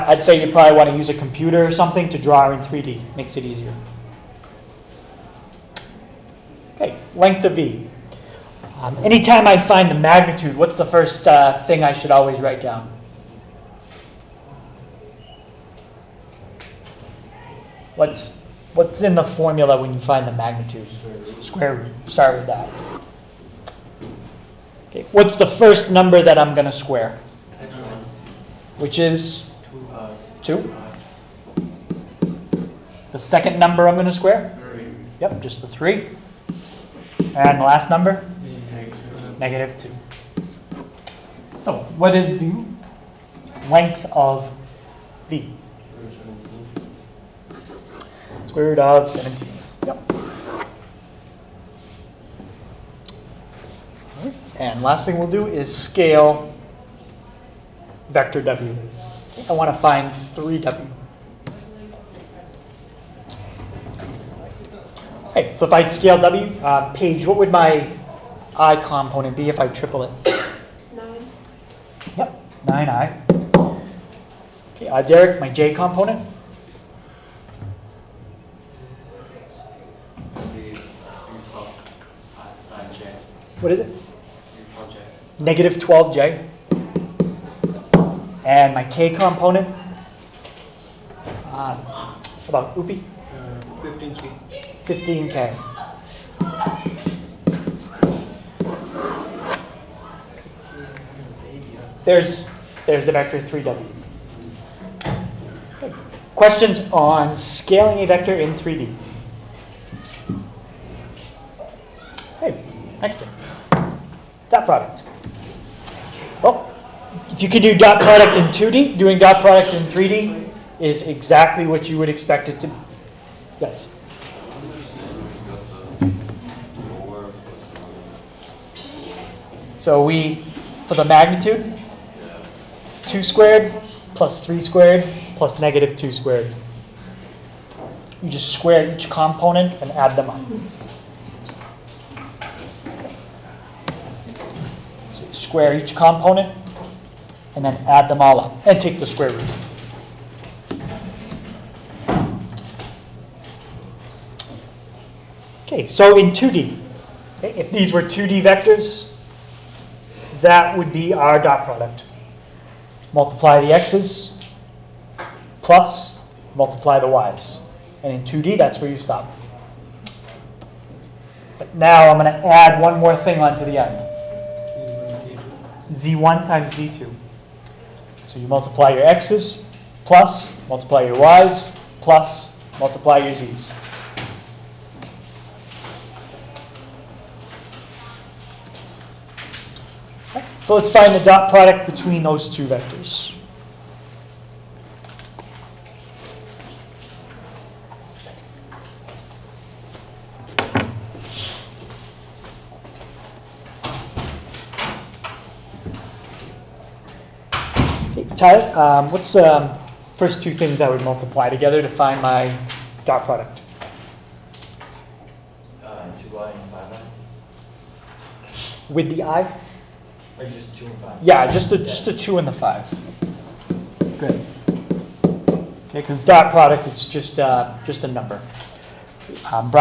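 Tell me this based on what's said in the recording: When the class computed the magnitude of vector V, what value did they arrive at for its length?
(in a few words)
Square root of 17.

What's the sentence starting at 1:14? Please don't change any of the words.
Okay, uh, Derek, my J component.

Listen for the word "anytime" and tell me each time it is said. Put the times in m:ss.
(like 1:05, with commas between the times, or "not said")
0:08.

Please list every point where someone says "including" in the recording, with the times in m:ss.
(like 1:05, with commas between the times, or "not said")
not said.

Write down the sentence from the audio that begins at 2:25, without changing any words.
So you square each component and then add them all up and take the square root.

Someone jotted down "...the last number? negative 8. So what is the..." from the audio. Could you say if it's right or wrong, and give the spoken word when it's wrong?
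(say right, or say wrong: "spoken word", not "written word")
wrong: "2", not "8".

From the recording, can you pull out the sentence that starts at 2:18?
You just square each component and add them up.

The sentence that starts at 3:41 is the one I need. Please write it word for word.
Yeah, just the, just the two and the five.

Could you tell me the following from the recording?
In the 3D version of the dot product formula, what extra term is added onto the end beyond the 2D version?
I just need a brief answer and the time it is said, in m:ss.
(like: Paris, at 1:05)
Z1 times Z2, at 2:55.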